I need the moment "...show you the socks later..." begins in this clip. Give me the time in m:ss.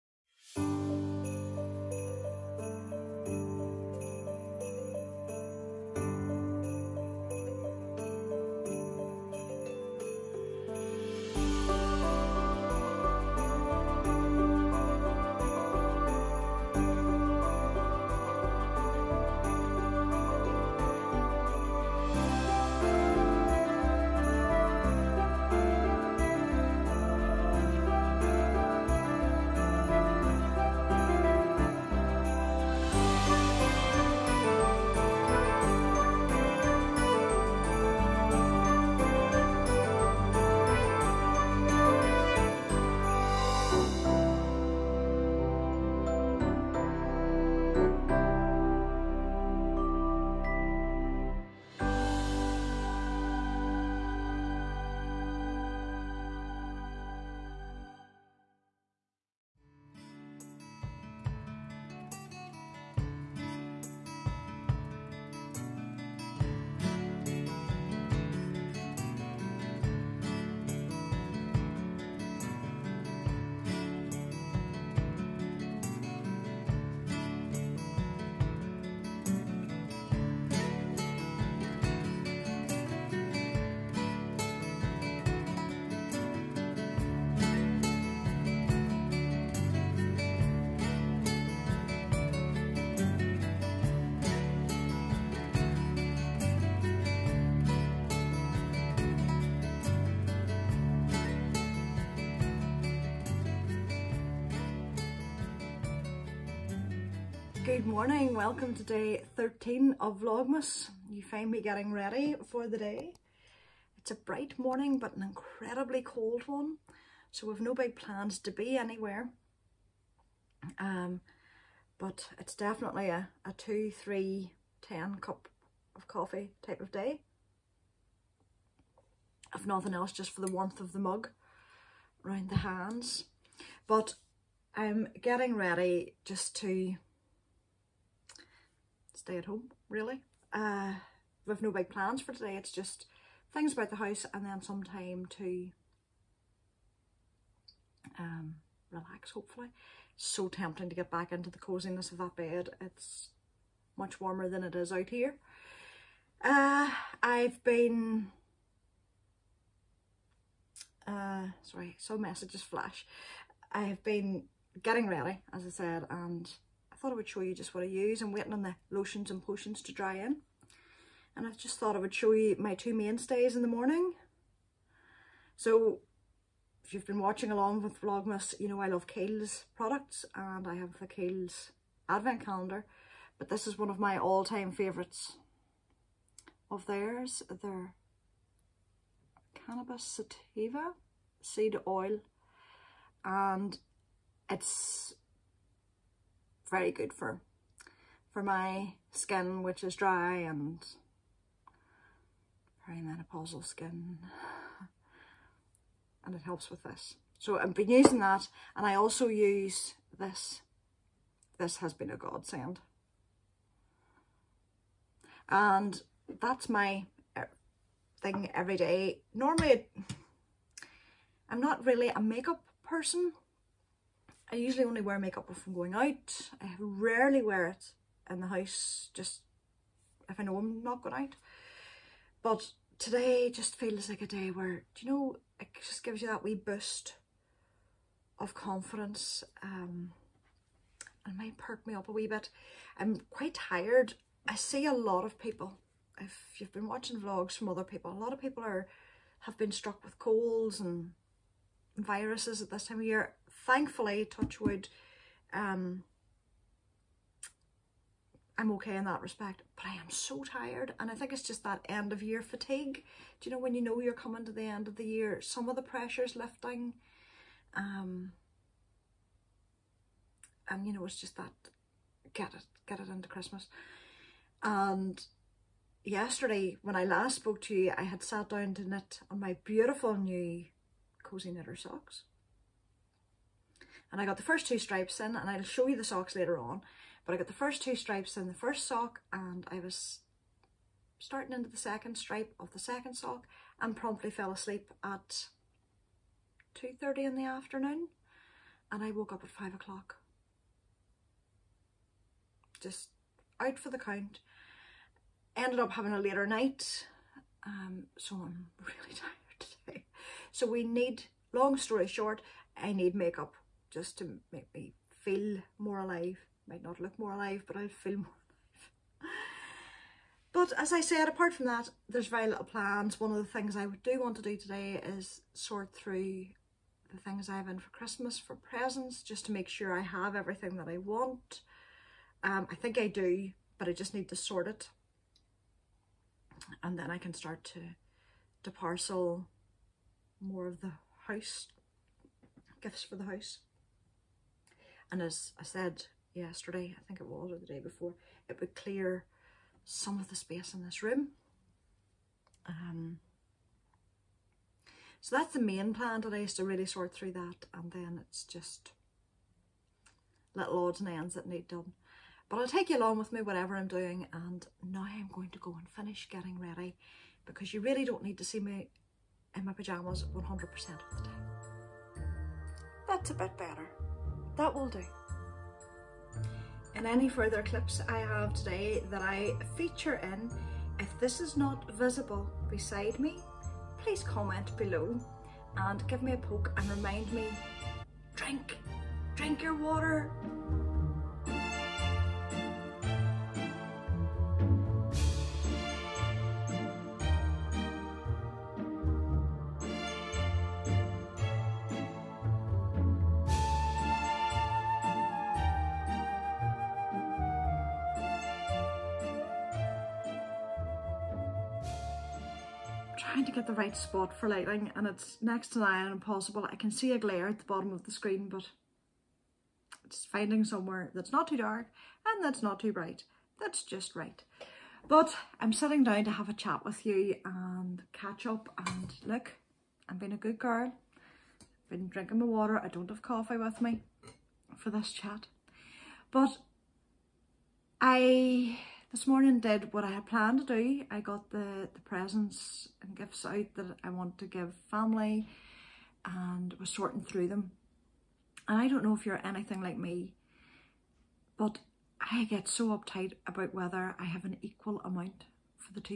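4:45.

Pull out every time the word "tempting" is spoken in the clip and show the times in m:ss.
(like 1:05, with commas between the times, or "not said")
2:30.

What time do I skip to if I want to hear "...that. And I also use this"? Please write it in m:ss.
3:28.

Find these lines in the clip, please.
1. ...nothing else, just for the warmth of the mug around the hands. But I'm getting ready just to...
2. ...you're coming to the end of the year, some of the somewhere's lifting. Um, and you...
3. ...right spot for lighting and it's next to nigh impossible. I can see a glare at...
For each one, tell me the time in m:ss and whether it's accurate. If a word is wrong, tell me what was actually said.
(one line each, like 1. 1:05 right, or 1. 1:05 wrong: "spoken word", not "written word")
1. 2:09 right
2. 4:23 wrong: "pressure", not "somewhere"
3. 6:53 right.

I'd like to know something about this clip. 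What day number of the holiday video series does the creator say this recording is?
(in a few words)
13.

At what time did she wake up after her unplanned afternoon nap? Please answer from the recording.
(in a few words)
5 o'clock.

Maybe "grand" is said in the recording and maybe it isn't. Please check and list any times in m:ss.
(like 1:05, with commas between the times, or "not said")
not said.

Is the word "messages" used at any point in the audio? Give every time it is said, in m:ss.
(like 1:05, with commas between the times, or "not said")
2:42.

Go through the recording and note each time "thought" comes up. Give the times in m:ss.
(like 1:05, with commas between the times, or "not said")
2:46, 2:51.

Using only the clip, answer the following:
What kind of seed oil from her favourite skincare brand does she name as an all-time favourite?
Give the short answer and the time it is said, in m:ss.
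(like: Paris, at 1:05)
Cannabis Sativa, at 3:09.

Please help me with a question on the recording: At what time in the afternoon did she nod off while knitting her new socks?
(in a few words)
2.30.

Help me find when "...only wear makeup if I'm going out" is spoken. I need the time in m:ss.
3:44.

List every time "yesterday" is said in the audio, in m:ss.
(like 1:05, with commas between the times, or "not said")
4:36, 5:46.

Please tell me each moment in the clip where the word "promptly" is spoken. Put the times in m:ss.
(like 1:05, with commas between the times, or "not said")
4:53.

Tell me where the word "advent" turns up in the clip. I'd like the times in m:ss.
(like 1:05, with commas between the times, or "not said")
3:02.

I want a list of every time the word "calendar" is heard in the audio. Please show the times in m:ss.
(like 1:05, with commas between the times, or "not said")
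3:02.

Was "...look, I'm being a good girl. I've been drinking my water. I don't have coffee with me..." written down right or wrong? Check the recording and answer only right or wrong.
right.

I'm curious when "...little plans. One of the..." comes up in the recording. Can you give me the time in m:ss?
5:22.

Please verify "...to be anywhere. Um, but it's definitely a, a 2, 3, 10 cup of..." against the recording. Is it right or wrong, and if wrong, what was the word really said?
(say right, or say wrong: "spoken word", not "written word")
right.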